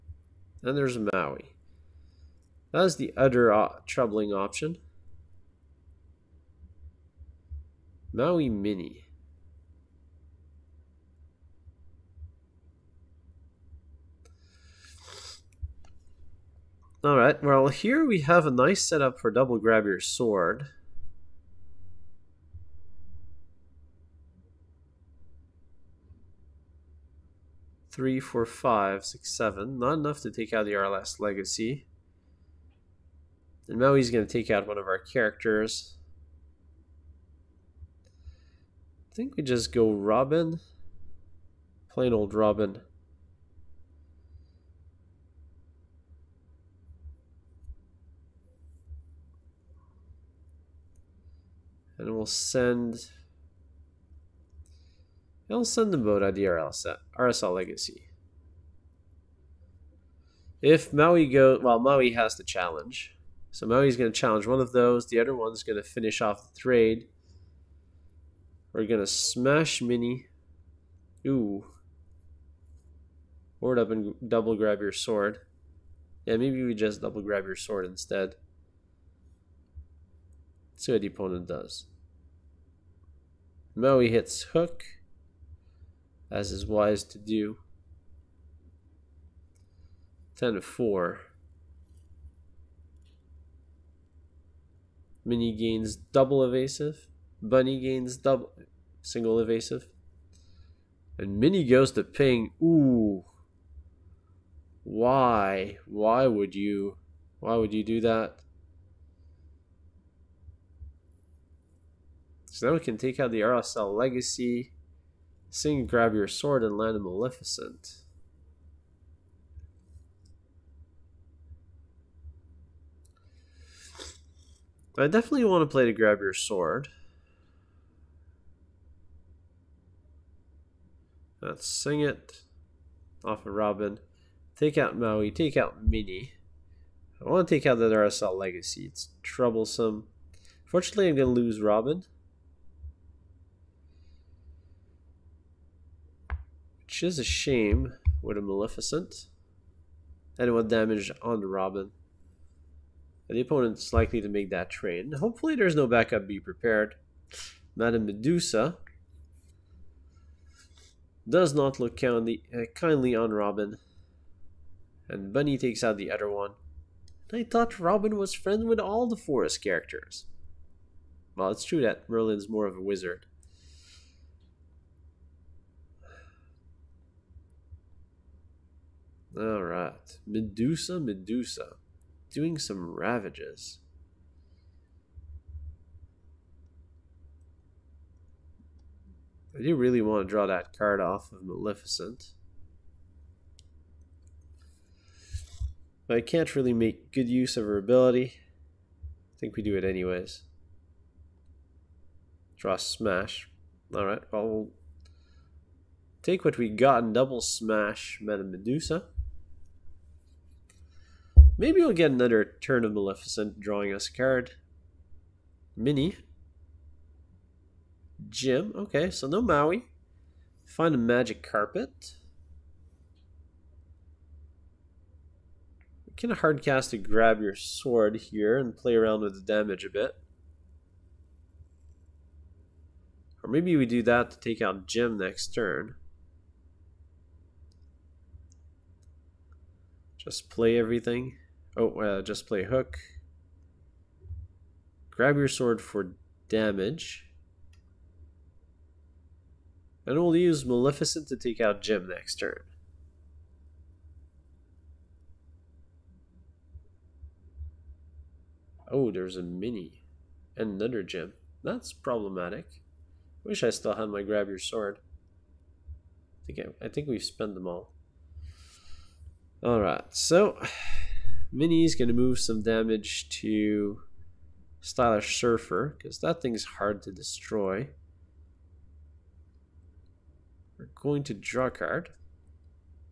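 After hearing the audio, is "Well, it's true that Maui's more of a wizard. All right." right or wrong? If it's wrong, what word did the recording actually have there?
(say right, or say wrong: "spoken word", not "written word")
wrong: "Merlin", not "Maui".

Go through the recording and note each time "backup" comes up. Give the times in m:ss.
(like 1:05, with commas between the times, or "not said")
2:35.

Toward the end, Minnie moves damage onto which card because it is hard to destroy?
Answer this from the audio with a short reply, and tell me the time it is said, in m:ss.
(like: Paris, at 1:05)
Stylish Surfer, at 4:34.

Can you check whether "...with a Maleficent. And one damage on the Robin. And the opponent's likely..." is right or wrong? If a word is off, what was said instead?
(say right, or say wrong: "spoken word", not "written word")
right.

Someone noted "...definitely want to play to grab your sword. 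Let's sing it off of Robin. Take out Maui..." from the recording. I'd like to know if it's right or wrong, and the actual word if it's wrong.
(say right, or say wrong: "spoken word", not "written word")
right.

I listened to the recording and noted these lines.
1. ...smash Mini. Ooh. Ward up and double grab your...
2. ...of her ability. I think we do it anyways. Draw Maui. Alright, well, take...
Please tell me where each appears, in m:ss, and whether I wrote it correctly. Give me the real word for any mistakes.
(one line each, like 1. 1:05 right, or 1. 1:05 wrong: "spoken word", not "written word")
1. 1:09 right
2. 3:17 wrong: "Smash", not "Maui".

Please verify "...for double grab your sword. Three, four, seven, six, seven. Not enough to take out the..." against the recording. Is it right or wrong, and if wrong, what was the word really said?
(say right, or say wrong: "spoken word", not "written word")
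wrong: "five", not "seven".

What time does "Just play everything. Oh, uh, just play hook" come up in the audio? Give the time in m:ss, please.
4:00.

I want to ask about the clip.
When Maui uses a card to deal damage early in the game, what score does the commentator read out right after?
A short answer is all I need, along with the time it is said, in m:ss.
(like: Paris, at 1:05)
10 to 4, at 1:30.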